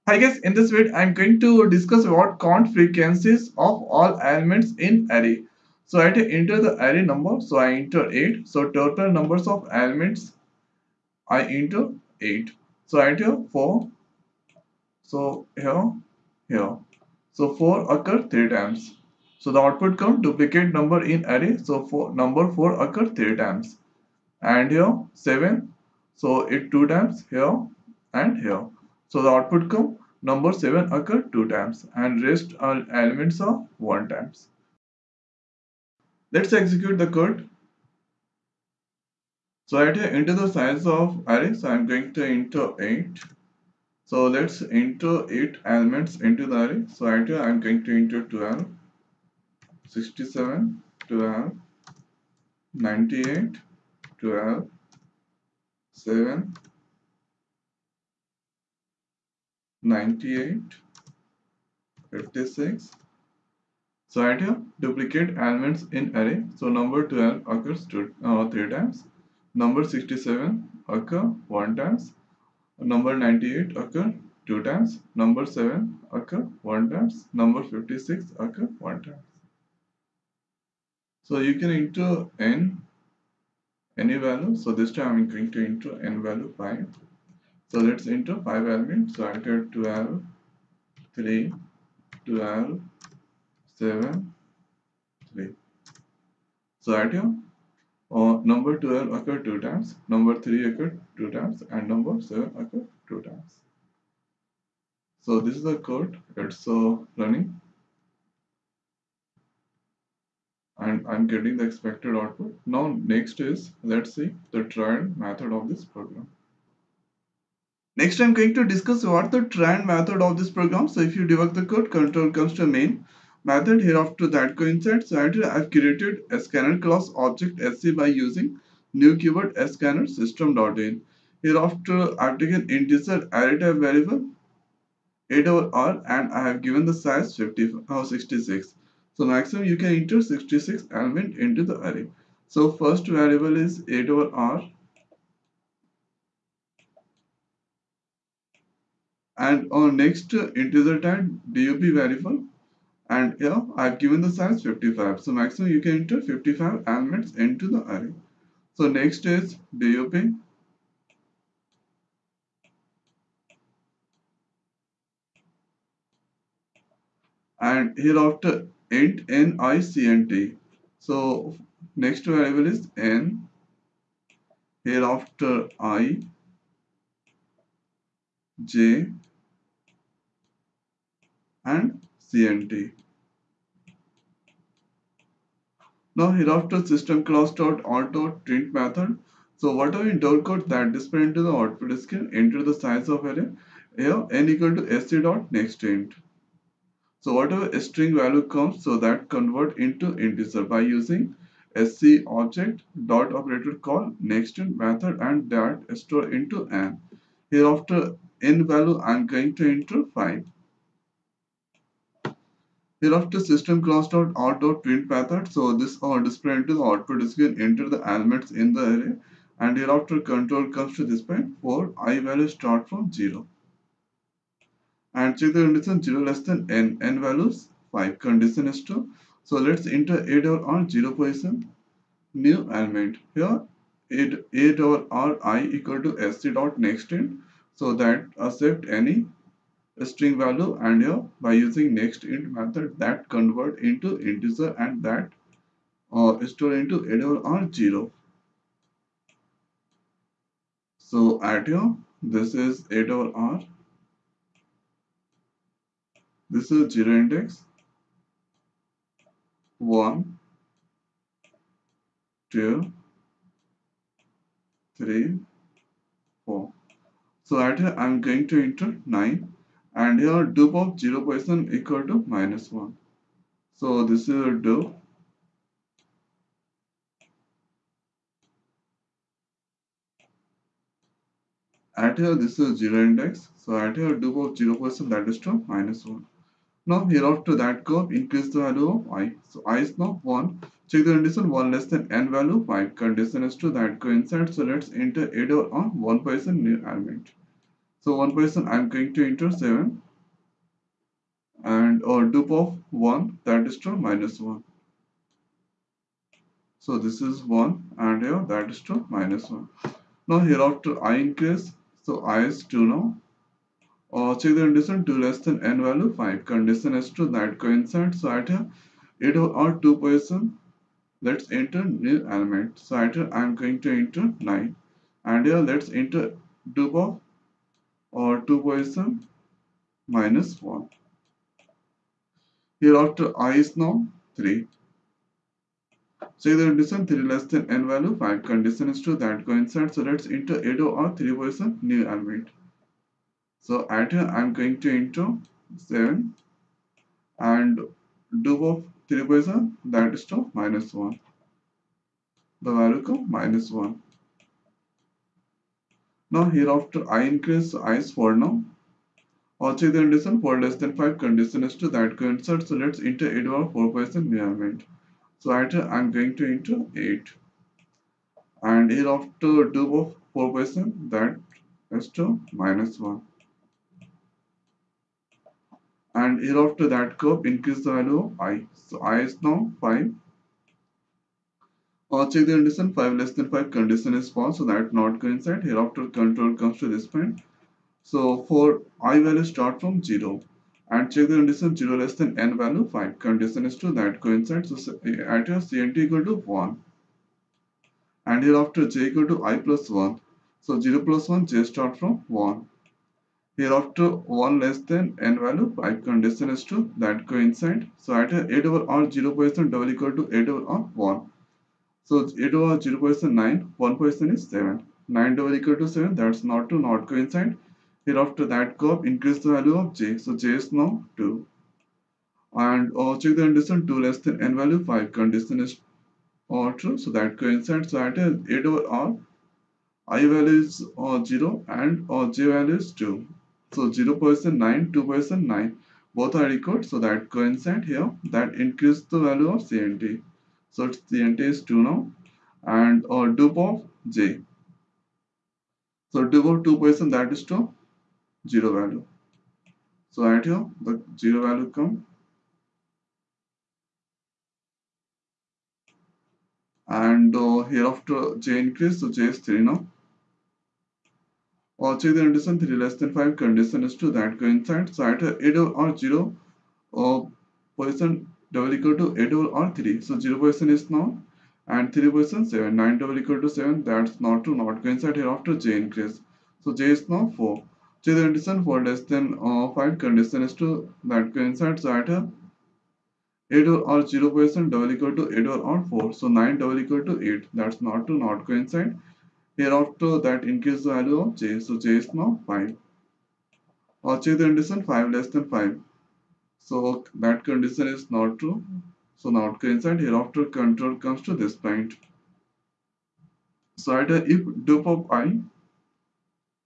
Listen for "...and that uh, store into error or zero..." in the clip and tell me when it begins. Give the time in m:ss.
4:04.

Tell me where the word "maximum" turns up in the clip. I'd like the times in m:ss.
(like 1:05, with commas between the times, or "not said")
2:19, 2:35.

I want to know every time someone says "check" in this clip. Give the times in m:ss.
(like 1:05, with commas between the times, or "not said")
3:45, 4:50, 5:14, 6:22, 6:31, 7:03, 7:41, 8:14.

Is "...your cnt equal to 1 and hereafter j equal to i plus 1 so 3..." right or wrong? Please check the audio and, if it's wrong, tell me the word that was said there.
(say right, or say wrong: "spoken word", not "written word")
wrong: "0", not "3".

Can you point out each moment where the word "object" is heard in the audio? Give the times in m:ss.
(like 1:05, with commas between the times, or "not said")
2:07, 3:22.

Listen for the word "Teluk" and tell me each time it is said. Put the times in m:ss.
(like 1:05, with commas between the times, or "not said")
not said.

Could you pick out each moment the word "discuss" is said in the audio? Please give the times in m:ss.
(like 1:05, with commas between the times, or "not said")
0:01, 1:58.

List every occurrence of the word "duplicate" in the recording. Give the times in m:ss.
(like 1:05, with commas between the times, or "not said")
0:20, 1:04.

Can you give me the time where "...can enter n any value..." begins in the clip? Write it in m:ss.
1:21.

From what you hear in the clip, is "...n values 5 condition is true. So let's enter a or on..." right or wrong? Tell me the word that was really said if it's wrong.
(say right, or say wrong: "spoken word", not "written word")
right.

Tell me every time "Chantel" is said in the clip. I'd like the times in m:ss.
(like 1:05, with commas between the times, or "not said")
not said.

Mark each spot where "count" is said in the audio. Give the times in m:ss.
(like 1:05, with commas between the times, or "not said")
0:02.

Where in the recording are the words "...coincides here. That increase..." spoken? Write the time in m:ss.
7:17.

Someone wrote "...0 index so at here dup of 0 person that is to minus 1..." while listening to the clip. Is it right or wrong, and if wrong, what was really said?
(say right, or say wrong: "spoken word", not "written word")
right.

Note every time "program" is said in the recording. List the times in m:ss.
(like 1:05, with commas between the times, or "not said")
1:55, 2:00.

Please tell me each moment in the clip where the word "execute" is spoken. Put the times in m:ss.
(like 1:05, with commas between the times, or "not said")
0:36.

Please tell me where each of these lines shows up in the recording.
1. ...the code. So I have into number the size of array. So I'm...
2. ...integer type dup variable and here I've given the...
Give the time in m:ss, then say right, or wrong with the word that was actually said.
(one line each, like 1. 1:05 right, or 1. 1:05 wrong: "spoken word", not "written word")
1. 0:36 wrong: "enter", not "number"
2. 2:30 right.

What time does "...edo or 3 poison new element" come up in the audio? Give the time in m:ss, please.
5:40.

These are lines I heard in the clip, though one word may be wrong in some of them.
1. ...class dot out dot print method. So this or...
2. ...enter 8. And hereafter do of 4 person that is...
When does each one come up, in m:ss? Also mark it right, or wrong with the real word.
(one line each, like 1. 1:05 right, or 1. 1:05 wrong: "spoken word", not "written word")
1. 3:33 right
2. 6:06 right.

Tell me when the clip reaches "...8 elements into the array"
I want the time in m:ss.
0:45.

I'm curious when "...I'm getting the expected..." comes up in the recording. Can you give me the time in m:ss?
1:51.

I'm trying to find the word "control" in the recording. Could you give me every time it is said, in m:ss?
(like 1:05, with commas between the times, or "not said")
2:01, 3:40, 6:26, 8:20.